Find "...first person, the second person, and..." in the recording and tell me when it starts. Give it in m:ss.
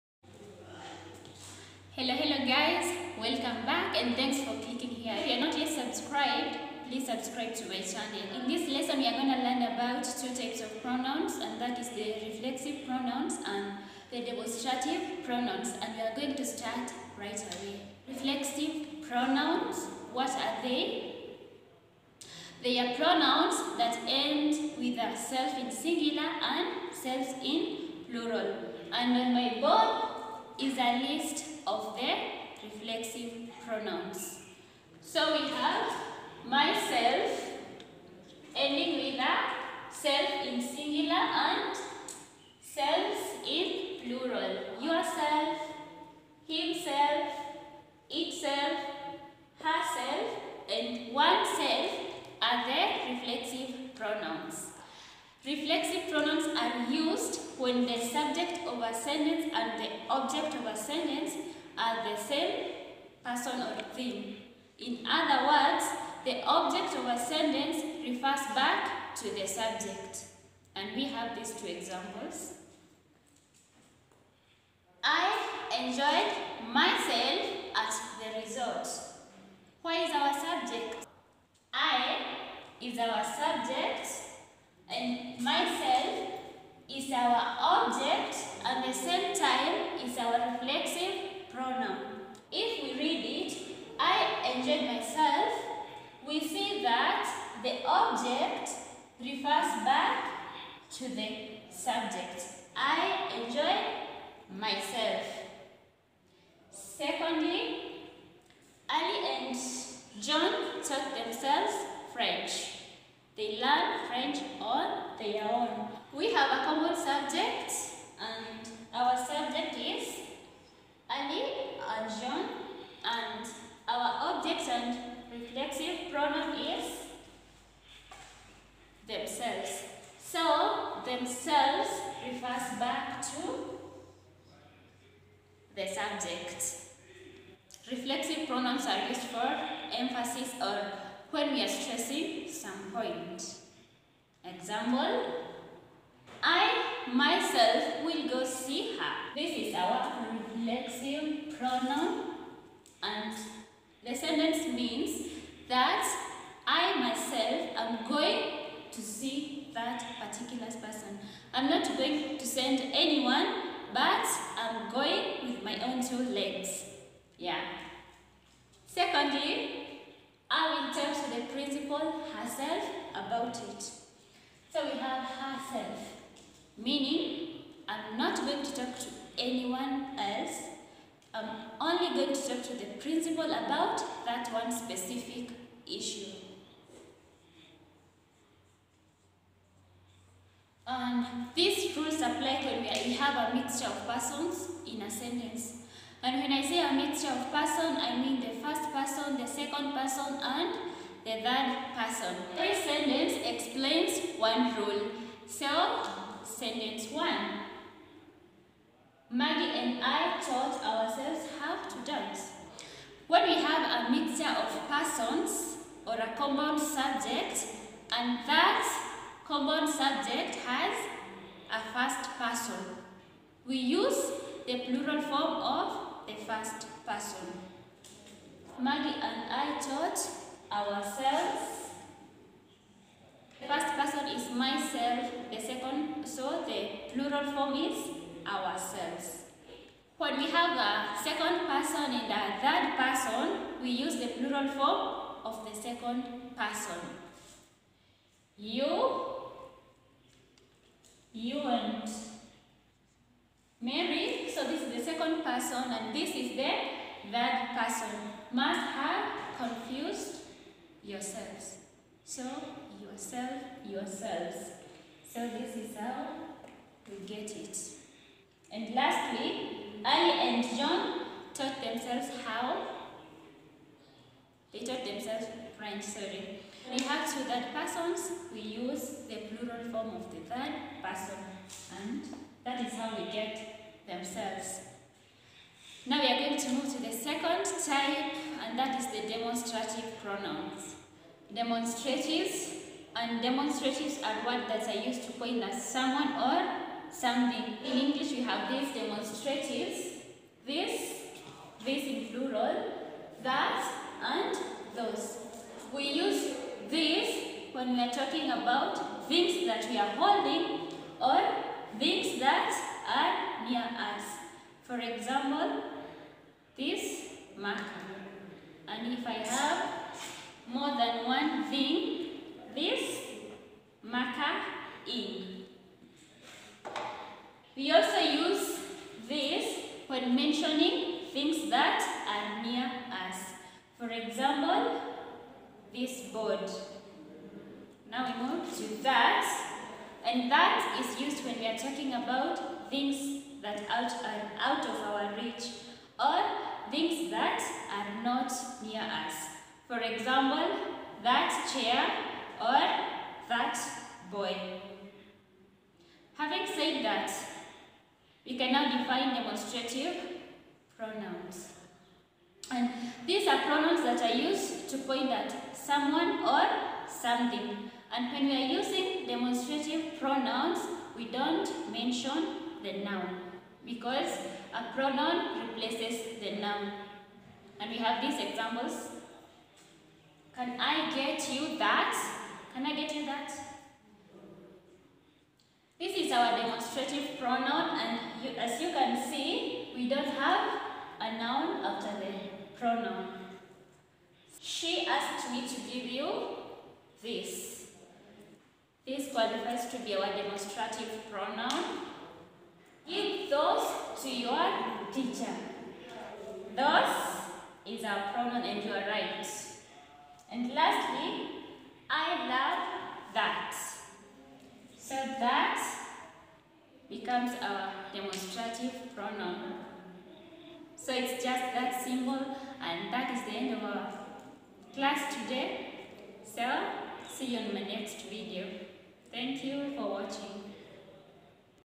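3:18.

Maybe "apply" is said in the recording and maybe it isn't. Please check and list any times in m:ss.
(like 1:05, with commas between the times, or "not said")
3:12.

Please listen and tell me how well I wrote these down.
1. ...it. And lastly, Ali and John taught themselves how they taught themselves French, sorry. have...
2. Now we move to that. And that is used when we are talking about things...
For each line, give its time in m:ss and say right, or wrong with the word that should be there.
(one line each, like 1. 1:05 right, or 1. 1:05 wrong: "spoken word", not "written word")
1. 4:27 right
2. 5:38 right.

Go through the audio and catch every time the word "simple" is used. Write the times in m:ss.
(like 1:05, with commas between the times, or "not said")
7:02.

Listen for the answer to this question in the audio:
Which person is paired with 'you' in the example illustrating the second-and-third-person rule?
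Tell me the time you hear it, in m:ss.
4:13.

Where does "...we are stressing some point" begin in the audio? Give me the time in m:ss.
2:21.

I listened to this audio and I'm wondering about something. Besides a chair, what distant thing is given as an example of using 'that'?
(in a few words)
boy.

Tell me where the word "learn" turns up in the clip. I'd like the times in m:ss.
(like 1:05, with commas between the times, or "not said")
0:09, 1:53.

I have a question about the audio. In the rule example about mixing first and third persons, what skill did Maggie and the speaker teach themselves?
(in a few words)
how to dance.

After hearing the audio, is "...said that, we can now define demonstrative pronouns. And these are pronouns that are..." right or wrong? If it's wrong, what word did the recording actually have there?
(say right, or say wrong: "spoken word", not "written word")
right.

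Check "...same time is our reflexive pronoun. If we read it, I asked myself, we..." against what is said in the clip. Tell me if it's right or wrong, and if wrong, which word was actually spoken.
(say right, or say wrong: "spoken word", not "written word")
wrong: "enjoyed", not "asked".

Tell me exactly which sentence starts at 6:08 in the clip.
And when we are using demonstrative pronouns, we don't mention the noun because a pronoun replaces the noun.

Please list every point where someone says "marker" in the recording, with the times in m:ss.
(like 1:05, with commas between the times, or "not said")
5:17, 5:24.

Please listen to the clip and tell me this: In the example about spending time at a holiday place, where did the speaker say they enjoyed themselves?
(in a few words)
the resort.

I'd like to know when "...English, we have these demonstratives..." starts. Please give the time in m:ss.
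4:57.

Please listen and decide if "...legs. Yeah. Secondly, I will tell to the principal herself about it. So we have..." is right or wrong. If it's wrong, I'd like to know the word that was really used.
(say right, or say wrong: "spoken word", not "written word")
right.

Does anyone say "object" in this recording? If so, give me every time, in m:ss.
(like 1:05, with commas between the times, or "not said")
1:00, 1:06, 1:27, 1:37.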